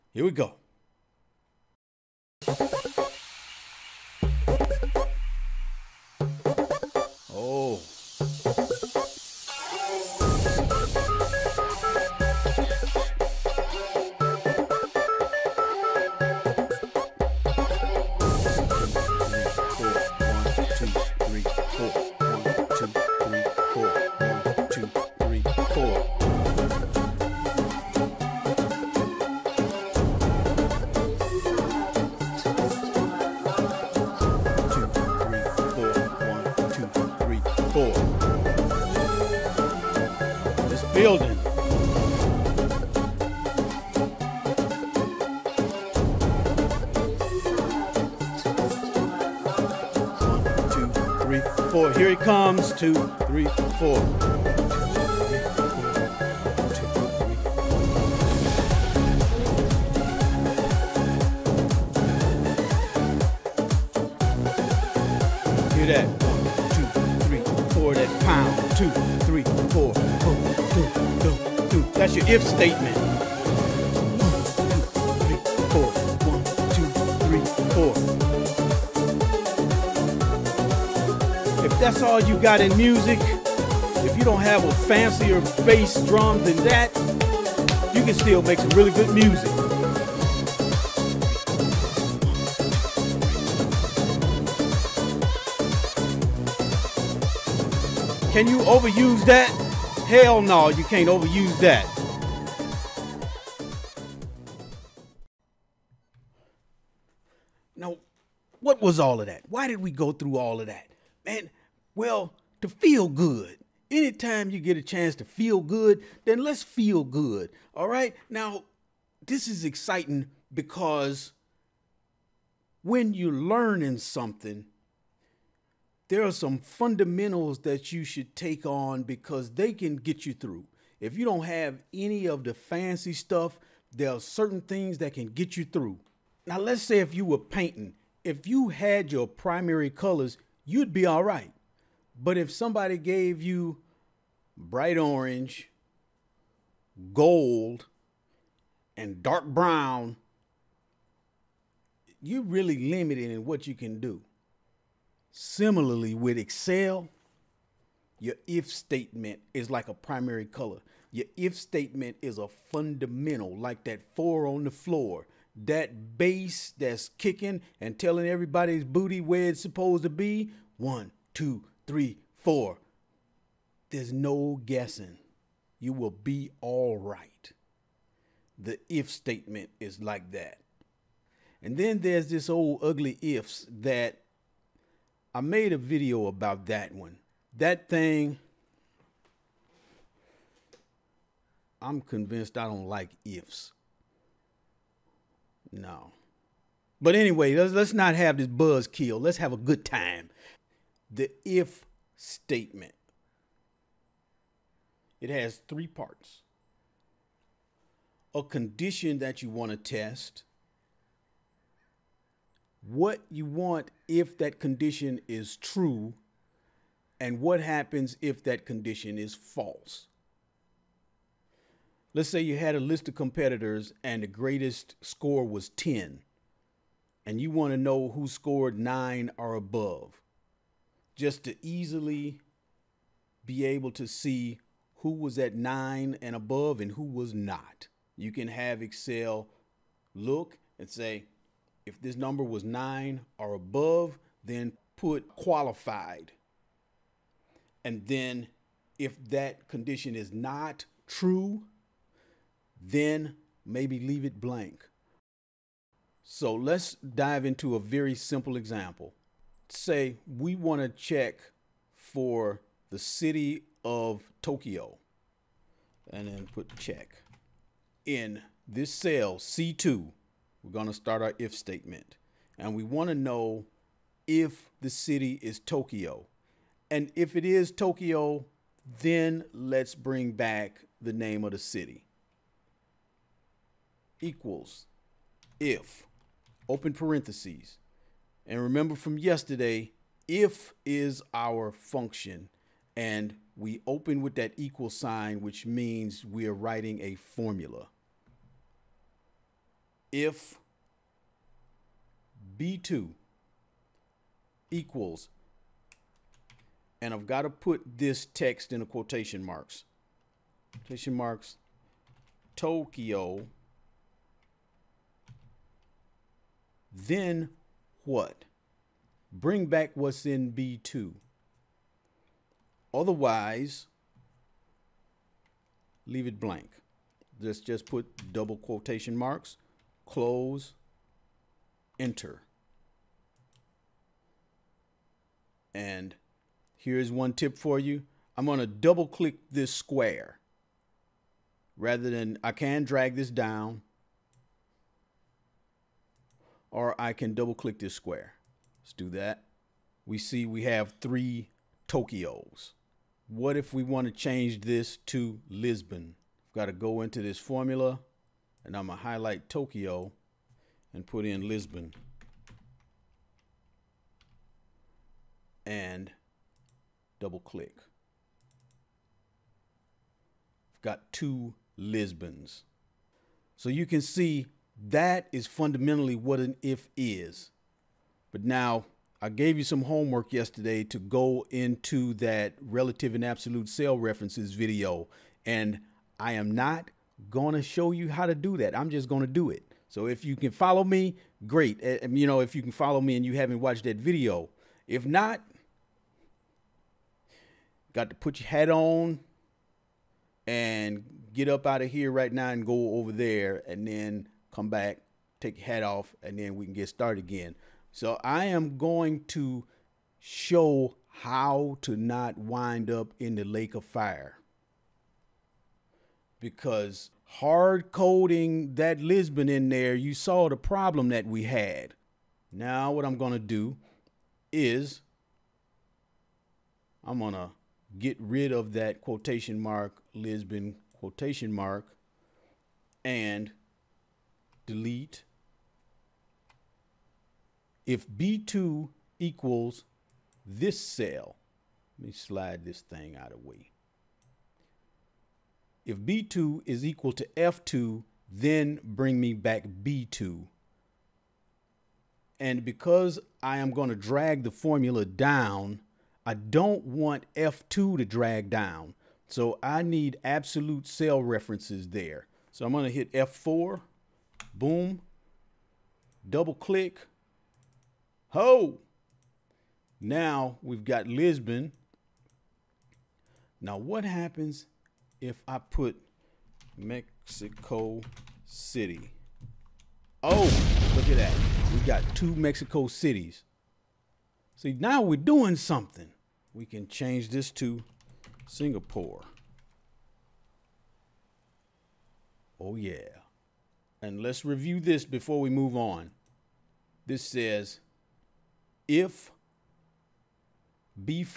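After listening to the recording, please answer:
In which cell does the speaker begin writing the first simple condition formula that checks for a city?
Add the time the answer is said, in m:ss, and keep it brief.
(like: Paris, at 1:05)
C2, at 4:29.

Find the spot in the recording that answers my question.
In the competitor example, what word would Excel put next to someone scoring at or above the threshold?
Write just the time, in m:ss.
4:05.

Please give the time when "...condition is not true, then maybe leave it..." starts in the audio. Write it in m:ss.
4:09.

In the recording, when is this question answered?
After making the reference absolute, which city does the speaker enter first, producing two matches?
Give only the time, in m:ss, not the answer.
7:56.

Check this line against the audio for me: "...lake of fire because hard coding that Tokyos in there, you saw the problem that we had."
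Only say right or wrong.
wrong.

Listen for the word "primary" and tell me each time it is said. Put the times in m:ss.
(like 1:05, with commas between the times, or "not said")
2:19, 2:39.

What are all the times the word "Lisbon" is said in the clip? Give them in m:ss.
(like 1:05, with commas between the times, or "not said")
5:55, 6:01, 6:11, 6:58, 7:10, 7:51.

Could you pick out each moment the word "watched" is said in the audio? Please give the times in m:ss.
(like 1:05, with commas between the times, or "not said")
6:33.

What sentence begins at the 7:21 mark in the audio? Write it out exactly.
Let me slide this thing out of the way if B2 is equal to F2, then bring me back B2.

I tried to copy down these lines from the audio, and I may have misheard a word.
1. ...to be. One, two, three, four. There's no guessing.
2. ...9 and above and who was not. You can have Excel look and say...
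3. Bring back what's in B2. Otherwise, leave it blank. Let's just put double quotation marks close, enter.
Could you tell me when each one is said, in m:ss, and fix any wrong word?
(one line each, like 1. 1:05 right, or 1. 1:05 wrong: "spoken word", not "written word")
1. 2:50 right
2. 3:55 right
3. 5:19 right.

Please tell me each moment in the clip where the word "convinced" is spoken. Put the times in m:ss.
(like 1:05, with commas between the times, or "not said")
3:12.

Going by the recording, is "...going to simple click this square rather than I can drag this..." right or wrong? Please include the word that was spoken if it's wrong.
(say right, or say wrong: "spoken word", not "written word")
wrong: "double", not "simple".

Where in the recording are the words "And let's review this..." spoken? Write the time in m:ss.
8:14.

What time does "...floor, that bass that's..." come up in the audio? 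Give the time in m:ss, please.
2:44.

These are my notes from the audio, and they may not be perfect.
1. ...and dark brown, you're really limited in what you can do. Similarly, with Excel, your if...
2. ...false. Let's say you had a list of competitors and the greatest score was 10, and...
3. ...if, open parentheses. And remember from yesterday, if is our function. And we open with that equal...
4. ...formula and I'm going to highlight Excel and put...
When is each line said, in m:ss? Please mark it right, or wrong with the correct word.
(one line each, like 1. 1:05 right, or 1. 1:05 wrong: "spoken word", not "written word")
1. 2:28 right
2. 3:39 right
3. 4:45 right
4. 5:57 wrong: "Tokyo", not "Excel".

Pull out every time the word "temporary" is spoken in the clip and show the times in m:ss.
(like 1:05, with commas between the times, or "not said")
not said.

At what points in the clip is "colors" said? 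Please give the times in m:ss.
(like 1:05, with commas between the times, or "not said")
2:19, 2:40.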